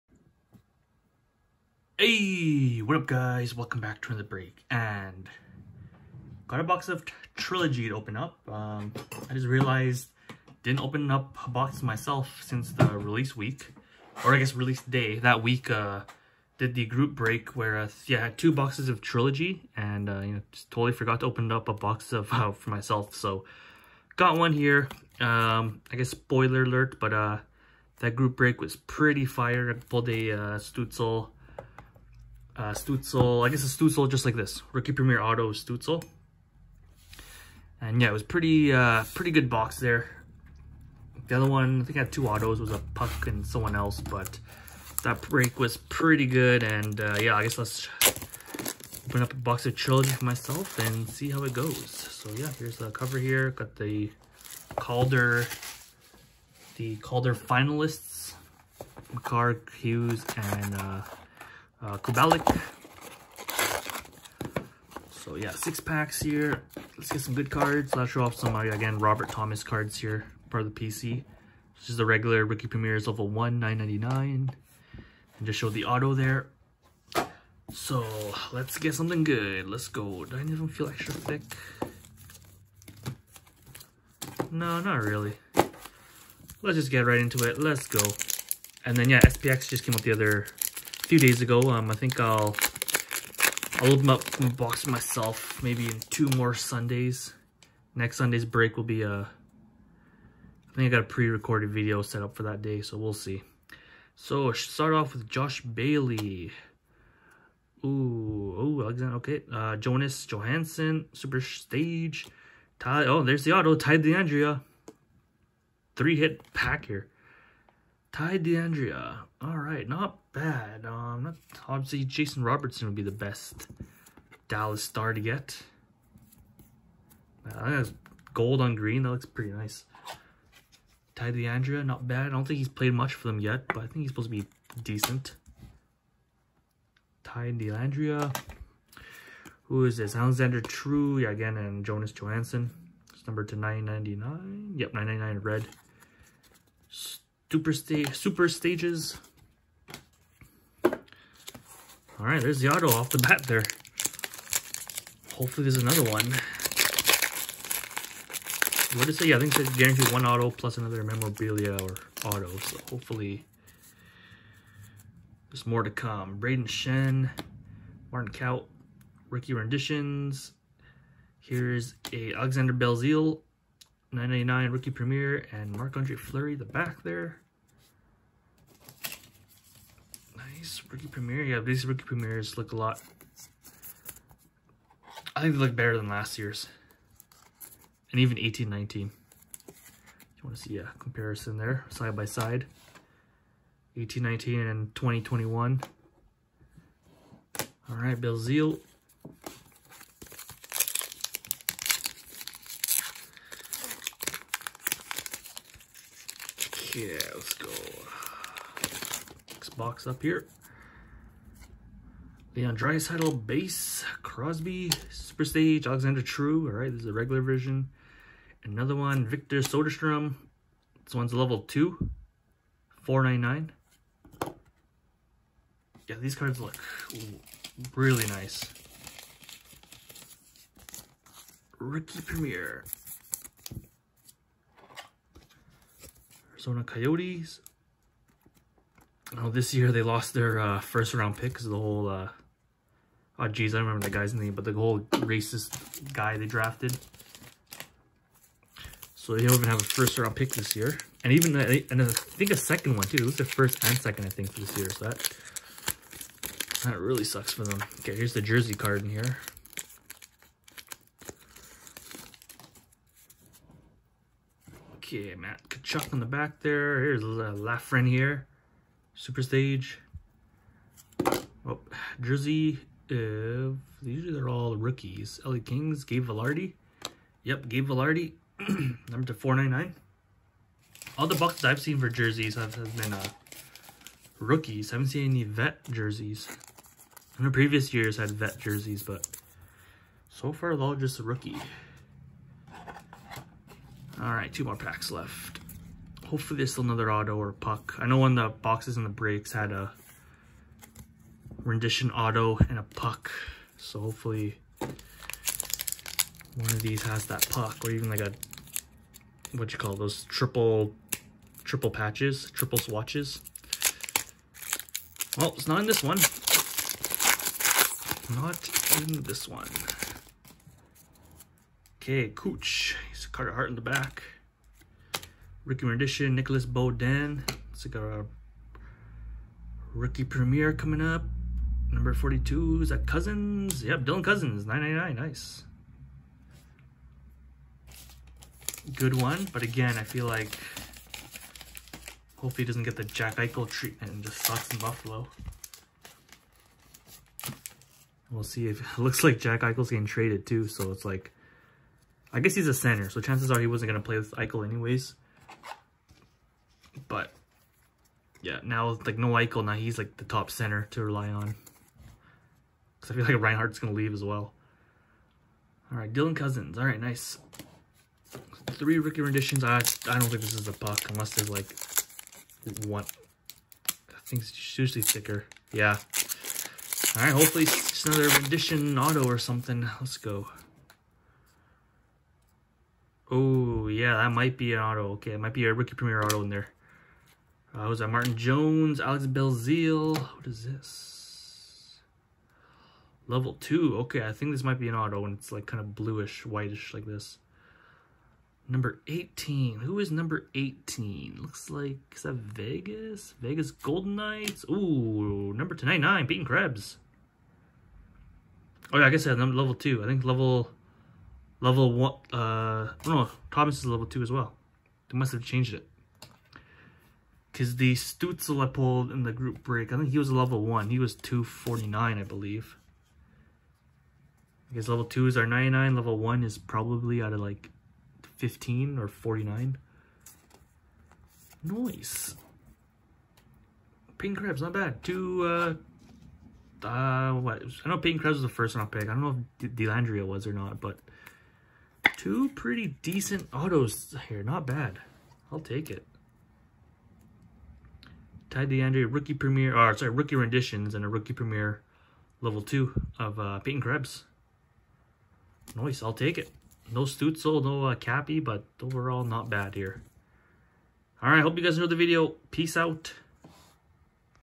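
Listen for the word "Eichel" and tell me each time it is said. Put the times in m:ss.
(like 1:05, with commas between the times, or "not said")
5:43, 5:49, 5:54, 5:59.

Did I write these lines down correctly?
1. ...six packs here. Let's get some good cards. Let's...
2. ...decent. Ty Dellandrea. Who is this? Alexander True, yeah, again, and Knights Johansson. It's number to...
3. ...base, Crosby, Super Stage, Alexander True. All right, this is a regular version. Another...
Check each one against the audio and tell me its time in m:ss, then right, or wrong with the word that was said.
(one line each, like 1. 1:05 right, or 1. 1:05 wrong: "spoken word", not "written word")
1. 1:05 right
2. 2:14 wrong: "Jonas", not "Knights"
3. 3:33 right.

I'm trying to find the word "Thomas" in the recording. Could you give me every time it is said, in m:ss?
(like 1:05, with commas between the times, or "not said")
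1:09, 6:53.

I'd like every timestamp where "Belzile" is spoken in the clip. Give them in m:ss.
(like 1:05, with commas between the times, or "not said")
2:52, 6:29.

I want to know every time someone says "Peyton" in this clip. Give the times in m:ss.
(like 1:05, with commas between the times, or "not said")
6:46, 7:33.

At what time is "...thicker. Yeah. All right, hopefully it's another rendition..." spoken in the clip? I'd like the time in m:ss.
6:15.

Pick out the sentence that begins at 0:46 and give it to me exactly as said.
And uh, yeah, I guess let's open up a box of trilogy for myself and see how it goes.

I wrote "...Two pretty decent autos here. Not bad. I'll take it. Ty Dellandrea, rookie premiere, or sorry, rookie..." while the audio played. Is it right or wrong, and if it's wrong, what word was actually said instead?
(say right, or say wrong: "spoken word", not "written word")
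right.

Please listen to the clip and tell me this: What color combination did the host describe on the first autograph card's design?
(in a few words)
gold on green.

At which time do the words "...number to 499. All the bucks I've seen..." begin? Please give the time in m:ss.
4:39.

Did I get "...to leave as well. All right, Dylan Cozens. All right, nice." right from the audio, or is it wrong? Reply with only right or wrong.
right.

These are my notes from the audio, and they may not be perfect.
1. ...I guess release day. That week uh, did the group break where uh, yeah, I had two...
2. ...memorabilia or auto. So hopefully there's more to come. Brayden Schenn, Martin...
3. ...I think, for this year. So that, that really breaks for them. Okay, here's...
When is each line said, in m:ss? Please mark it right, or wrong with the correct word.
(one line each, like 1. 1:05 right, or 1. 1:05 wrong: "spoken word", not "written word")
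1. 0:14 right
2. 2:41 right
3. 4:14 wrong: "sucks", not "breaks".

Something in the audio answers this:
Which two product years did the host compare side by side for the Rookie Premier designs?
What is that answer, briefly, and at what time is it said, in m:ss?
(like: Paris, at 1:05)
1819 and 2021, at 3:13.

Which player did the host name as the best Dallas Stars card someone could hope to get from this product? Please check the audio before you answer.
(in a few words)
Jason Robertson.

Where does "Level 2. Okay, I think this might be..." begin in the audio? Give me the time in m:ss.
6:33.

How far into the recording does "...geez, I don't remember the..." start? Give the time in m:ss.
4:03.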